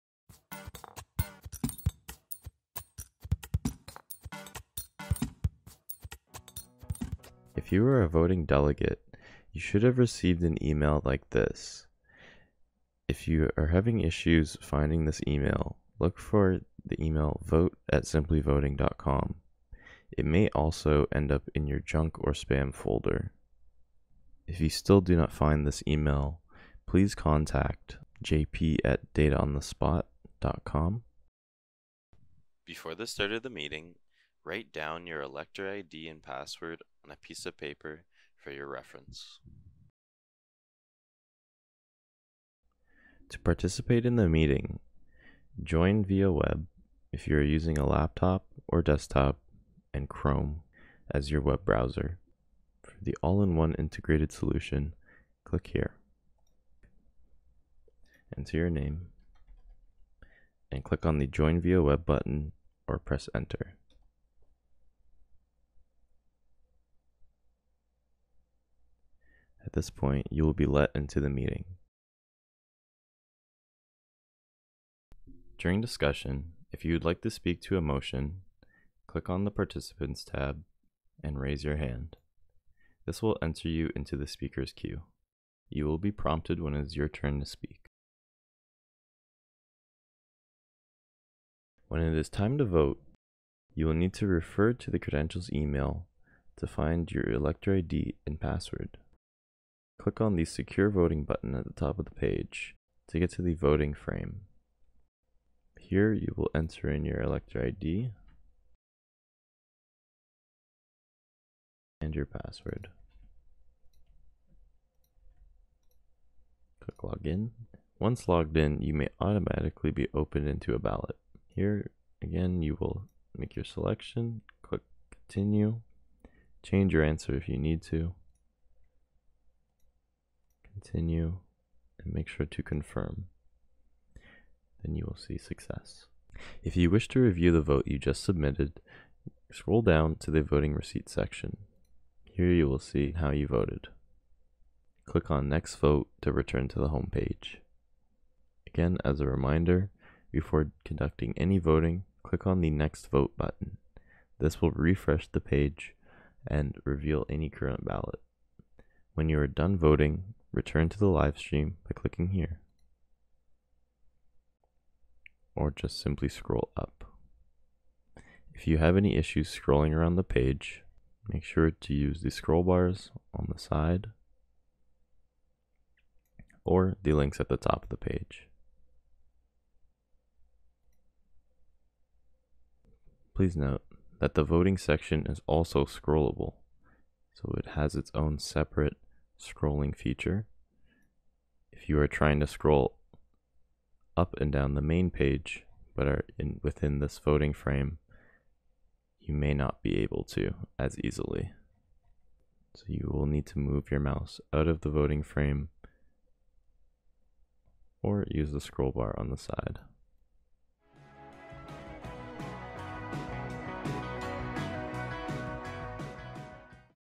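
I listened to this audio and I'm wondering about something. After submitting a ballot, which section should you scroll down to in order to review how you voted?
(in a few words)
voting receipt.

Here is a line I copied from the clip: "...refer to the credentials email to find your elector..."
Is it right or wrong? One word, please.
right.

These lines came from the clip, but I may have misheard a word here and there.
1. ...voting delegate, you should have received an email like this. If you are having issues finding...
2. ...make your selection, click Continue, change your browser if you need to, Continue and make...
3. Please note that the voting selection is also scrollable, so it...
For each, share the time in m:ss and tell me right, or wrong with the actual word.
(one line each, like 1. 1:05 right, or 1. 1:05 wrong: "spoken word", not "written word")
1. 0:08 right
2. 2:03 wrong: "answer", not "browser"
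3. 3:03 wrong: "section", not "selection".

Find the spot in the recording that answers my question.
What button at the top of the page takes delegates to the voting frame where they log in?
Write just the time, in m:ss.
1:40.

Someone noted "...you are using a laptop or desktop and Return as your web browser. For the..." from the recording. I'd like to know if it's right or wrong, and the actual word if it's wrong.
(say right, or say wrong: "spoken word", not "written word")
wrong: "Chrome", not "Return".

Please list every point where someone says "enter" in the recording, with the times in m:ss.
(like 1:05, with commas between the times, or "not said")
0:58, 1:03, 1:23, 1:46.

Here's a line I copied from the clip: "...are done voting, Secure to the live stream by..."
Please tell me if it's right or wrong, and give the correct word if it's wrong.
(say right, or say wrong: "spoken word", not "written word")
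wrong: "Return", not "Secure".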